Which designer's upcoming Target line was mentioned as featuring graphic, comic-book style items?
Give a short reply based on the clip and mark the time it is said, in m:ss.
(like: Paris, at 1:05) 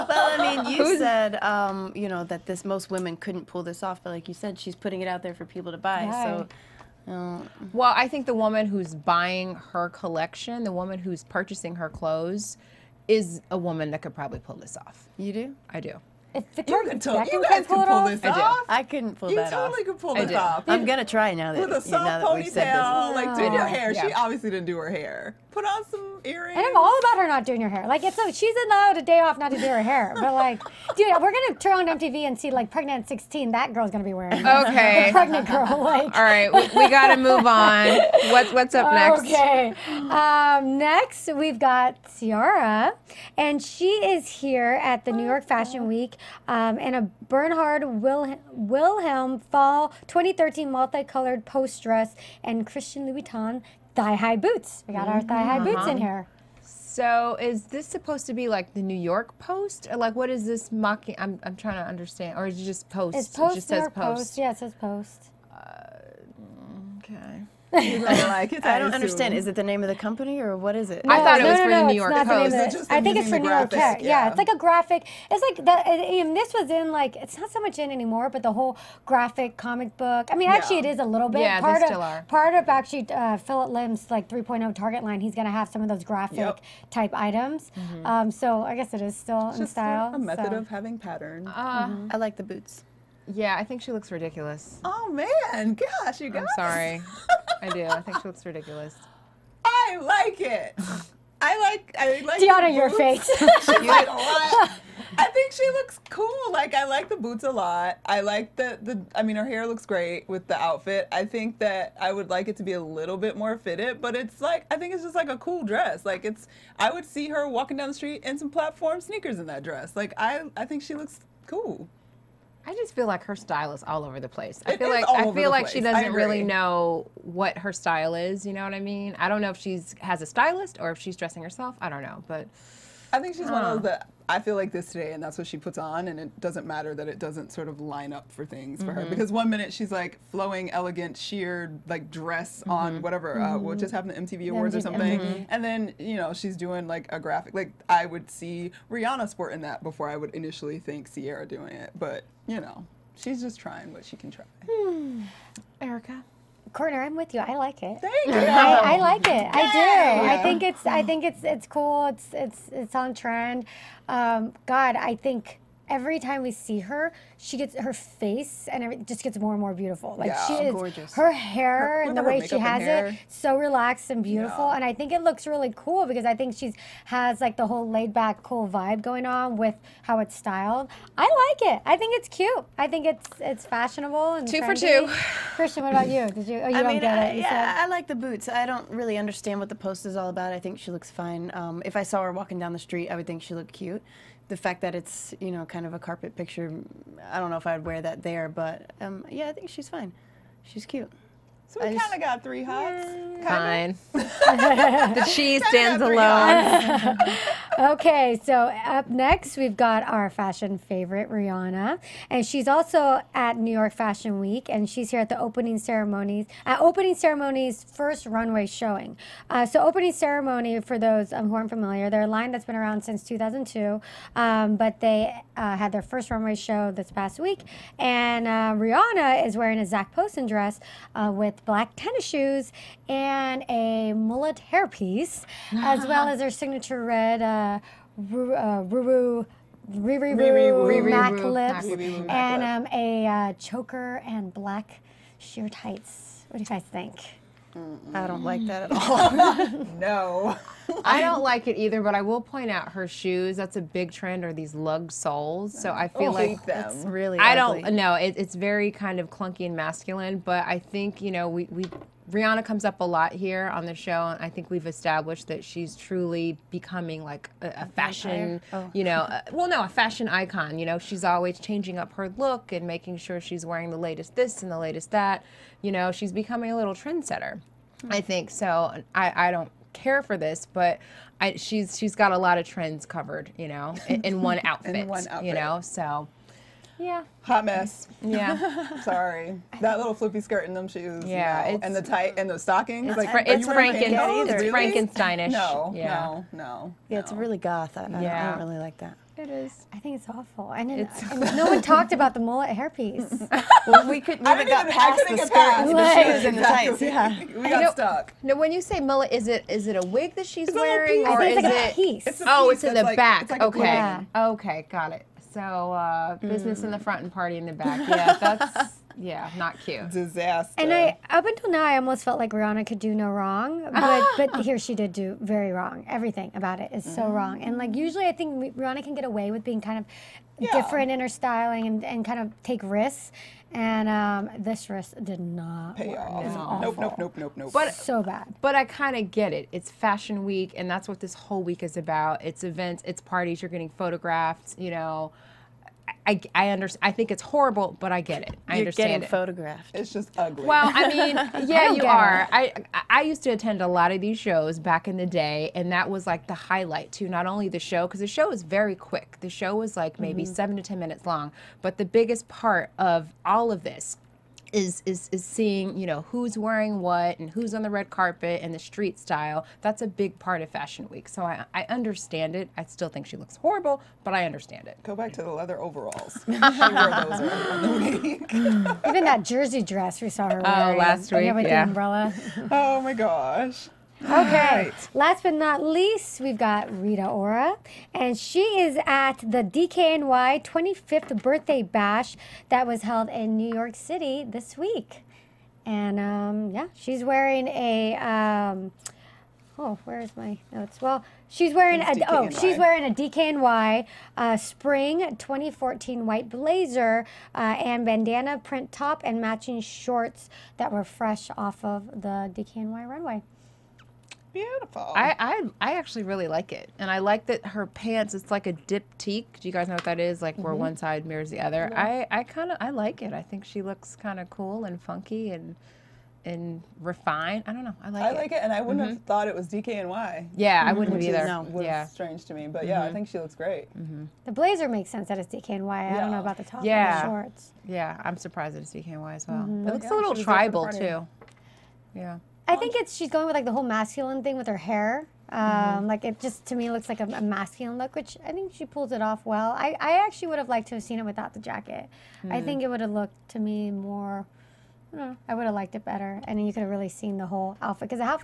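Phillip Lim, at 1:23.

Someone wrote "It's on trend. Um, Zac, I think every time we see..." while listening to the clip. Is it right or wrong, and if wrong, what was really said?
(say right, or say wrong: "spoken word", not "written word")
wrong: "God", not "Zac".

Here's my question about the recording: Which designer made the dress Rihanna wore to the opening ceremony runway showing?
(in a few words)
Zac Posen.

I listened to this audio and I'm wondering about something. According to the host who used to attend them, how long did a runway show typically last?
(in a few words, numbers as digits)
7 to 10 minutes.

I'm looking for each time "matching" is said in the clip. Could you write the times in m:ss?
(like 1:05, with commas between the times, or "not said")
6:49.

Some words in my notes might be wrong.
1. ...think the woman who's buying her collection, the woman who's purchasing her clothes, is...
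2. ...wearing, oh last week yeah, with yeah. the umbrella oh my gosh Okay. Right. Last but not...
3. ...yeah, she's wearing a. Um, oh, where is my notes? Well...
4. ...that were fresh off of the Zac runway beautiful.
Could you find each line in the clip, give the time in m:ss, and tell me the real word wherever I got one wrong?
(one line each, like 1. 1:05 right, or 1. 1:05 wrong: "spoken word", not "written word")
1. 0:08 right
2. 6:20 right
3. 6:36 right
4. 6:50 wrong: "DKNY", not "Zac".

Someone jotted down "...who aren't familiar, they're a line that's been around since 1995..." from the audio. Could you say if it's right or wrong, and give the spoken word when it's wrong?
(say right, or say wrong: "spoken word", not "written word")
wrong: "2002", not "1995".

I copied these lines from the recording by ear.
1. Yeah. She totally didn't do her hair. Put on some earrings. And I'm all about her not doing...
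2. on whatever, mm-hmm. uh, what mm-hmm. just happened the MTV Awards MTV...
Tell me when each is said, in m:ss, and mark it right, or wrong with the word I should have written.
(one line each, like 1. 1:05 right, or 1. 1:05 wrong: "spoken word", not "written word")
1. 0:23 wrong: "obviously", not "totally"
2. 2:22 right.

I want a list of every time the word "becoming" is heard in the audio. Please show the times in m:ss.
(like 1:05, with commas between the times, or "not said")
4:26, 4:36.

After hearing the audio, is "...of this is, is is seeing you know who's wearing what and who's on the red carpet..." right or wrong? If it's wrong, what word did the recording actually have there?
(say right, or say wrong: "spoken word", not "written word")
right.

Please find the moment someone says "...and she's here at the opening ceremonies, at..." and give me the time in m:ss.
3:34.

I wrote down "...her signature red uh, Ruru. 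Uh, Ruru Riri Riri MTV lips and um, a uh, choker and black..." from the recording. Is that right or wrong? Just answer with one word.
wrong.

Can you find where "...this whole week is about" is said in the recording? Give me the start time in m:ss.
5:41.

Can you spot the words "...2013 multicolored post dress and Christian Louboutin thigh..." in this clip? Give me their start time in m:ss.
0:50.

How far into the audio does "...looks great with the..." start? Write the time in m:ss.
1:49.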